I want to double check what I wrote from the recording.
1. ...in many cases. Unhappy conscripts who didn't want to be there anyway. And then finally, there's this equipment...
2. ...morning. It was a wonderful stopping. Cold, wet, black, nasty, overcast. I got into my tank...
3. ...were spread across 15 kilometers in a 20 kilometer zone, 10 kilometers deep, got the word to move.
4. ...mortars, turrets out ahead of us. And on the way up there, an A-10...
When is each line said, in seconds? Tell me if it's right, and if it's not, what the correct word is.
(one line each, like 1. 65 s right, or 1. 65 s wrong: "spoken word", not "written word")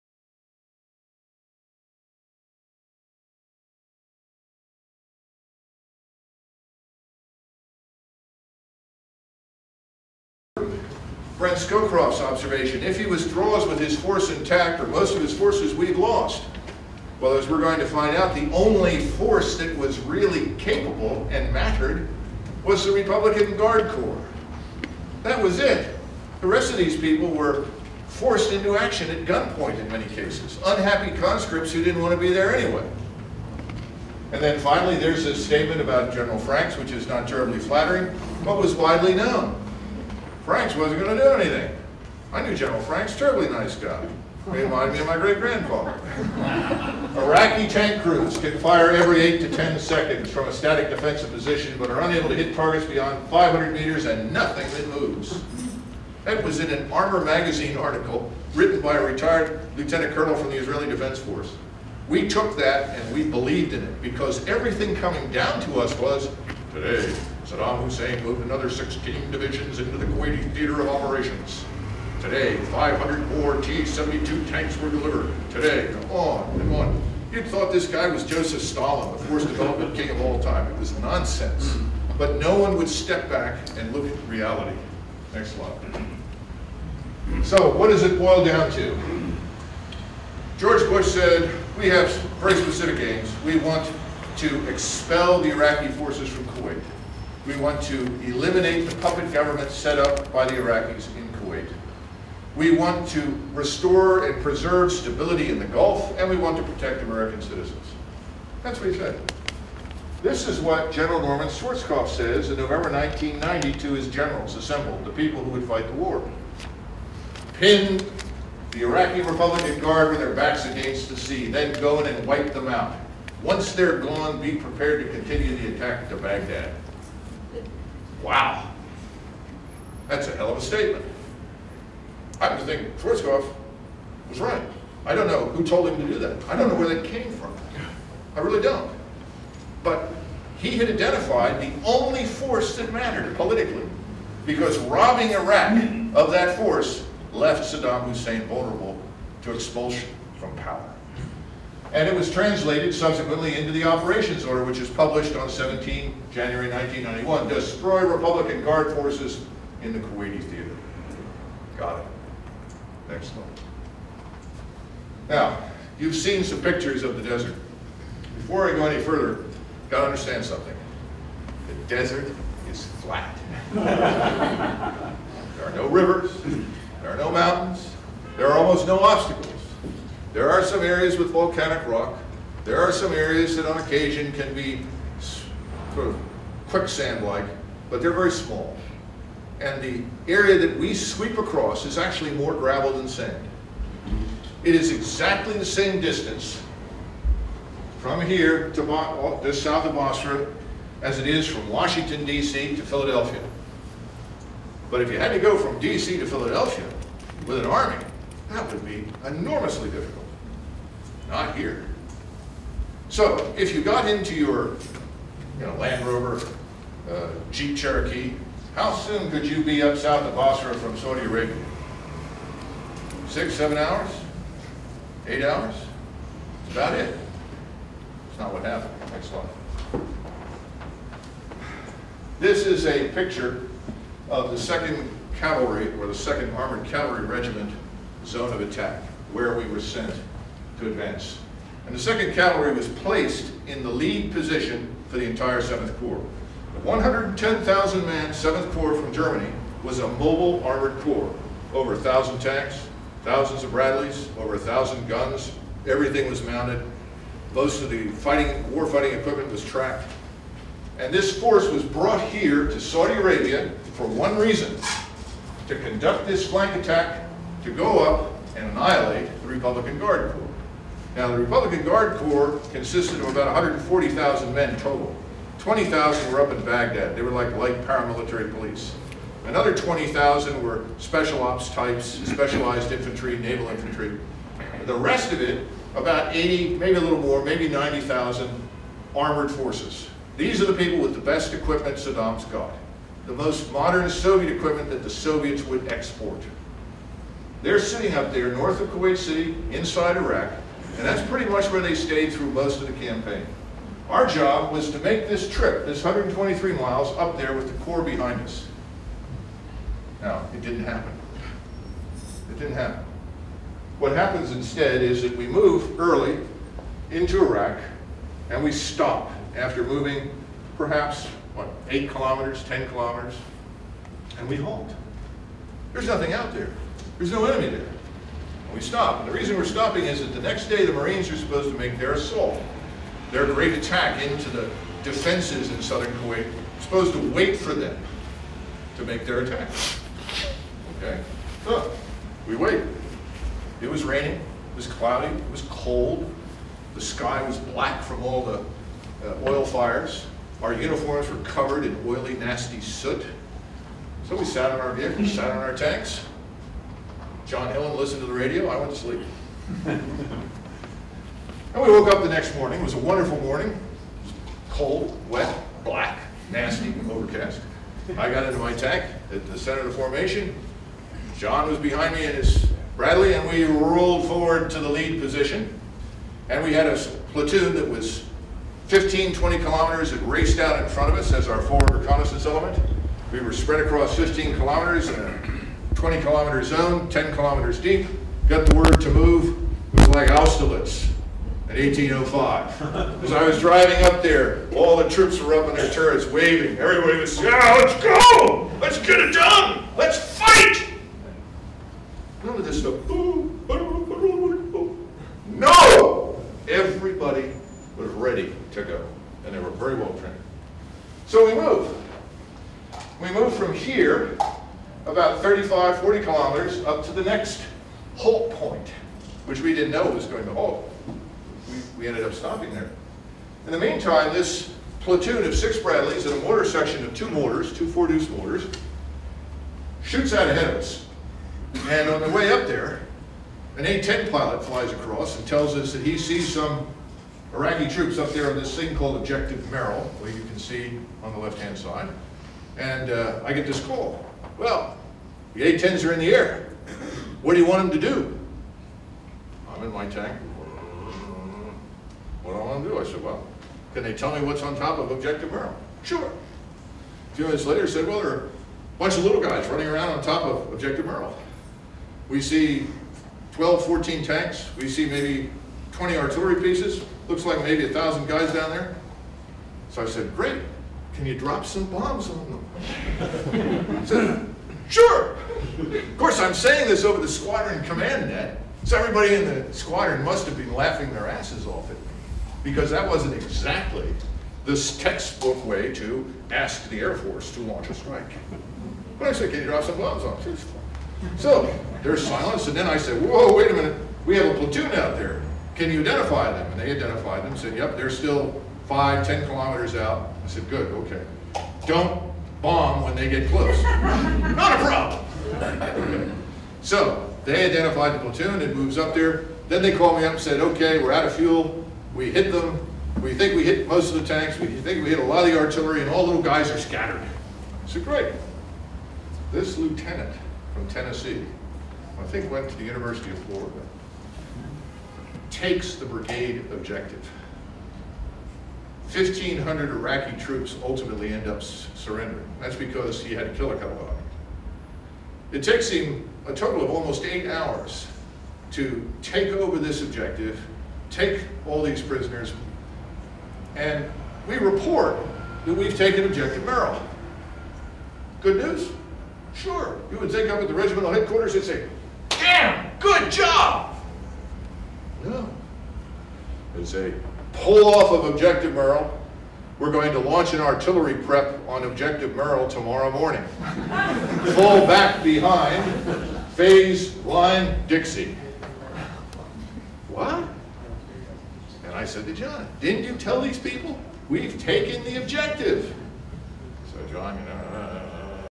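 1. 29 s wrong: "statement", not "equipment"
2. 362 s wrong: "morning", not "stopping"
3. 383 s right
4. 428 s wrong: "shoots", not "turrets".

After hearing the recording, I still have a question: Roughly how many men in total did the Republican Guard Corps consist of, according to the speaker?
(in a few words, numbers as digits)
140,000.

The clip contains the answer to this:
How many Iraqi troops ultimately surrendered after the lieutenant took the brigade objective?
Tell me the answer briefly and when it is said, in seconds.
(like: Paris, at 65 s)
1,500, at 529 s.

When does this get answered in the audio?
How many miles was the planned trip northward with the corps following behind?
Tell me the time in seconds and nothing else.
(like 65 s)
306 s.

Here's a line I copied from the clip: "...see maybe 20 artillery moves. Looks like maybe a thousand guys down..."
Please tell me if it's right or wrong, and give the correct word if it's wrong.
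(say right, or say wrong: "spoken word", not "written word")
wrong: "pieces", not "moves".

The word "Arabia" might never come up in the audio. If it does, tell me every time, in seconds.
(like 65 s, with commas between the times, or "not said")
221 s, 263 s.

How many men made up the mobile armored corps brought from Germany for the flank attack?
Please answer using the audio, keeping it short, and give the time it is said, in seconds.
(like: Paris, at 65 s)
110,000, at 246 s.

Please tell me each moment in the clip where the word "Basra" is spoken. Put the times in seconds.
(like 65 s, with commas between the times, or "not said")
199 s, 220 s.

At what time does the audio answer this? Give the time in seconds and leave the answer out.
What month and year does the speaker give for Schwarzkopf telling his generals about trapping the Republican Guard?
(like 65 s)
112 s.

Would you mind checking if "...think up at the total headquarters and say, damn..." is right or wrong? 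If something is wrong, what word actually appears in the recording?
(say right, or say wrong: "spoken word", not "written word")
wrong: "regimental", not "total".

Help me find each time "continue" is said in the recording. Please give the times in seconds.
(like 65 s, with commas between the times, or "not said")
125 s.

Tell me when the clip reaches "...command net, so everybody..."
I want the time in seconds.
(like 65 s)
477 s.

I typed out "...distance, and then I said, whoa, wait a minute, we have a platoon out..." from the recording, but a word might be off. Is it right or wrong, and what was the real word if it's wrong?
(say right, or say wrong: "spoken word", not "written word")
wrong: "silence", not "distance".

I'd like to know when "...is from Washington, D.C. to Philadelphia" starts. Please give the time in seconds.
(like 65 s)
201 s.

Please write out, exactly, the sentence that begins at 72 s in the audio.
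Today, 500 more T-72 tanks were delivered.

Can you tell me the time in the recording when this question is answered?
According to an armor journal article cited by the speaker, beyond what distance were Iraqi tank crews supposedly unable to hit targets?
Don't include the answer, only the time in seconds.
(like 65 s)
53 s.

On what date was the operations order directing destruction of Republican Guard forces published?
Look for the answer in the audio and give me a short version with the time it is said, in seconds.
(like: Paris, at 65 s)
17 January 1991, at 155 s.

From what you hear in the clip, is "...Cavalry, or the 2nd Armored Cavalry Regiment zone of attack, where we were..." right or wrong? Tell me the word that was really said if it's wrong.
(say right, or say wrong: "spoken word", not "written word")
right.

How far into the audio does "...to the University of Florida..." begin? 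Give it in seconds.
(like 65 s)
522 s.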